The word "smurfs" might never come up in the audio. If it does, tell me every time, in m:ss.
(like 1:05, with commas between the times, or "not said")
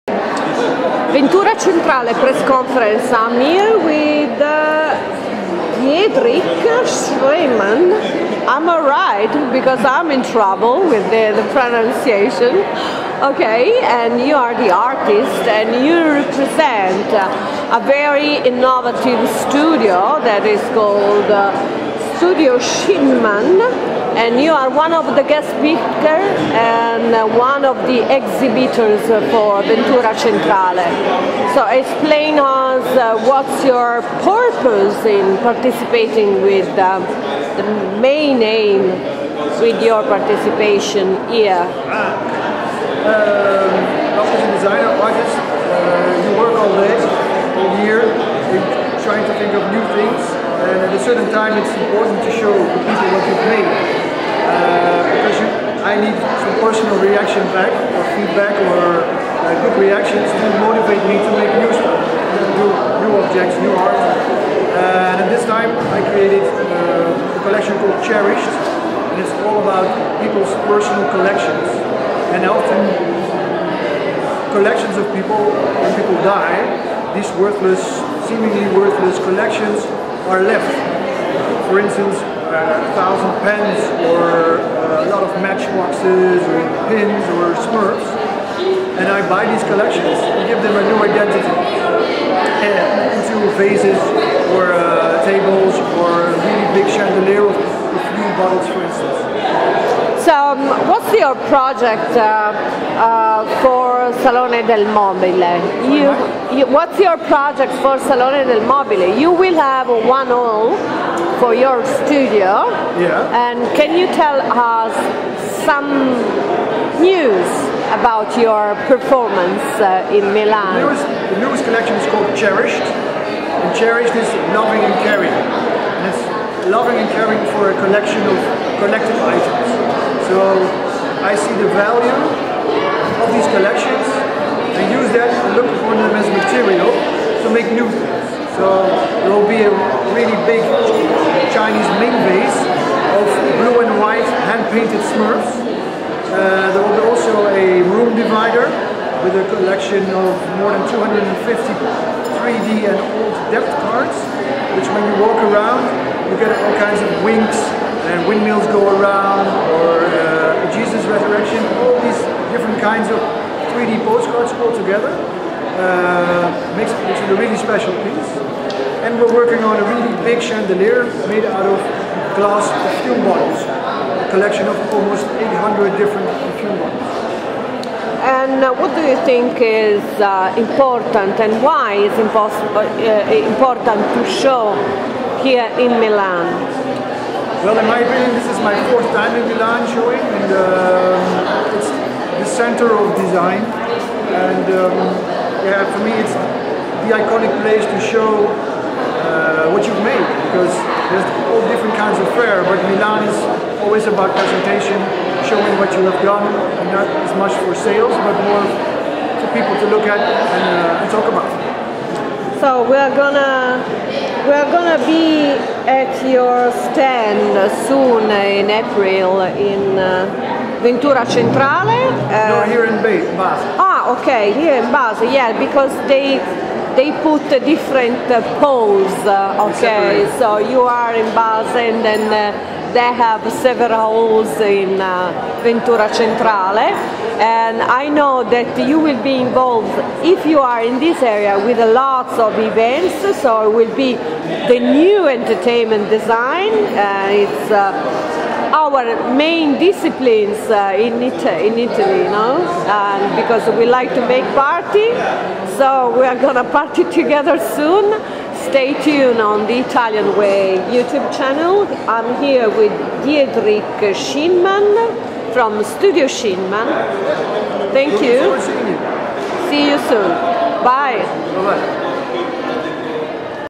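1:27, 2:25.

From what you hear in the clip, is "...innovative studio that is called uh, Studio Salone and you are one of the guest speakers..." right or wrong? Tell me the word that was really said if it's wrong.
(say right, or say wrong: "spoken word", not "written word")
wrong: "Schneemann", not "Salone".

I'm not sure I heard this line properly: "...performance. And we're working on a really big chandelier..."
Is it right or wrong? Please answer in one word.
wrong.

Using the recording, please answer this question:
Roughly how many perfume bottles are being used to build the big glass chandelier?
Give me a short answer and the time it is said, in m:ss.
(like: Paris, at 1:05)
800, at 2:54.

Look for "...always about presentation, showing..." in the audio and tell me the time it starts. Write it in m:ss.
3:23.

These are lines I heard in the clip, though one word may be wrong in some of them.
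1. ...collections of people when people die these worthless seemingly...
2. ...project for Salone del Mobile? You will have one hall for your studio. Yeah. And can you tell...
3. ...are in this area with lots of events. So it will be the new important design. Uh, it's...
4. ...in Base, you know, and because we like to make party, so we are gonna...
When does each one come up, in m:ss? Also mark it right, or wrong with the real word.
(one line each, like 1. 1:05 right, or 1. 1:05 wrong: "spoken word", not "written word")
1. 1:14 right
2. 1:47 right
3. 4:00 wrong: "entertainment", not "important"
4. 4:11 wrong: "Italy", not "Base".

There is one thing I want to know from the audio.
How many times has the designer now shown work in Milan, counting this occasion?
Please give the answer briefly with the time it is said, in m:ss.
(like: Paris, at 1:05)
4, at 3:08.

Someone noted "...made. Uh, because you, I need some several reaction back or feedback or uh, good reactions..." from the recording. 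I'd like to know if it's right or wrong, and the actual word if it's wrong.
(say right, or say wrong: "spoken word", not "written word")
wrong: "personal", not "several".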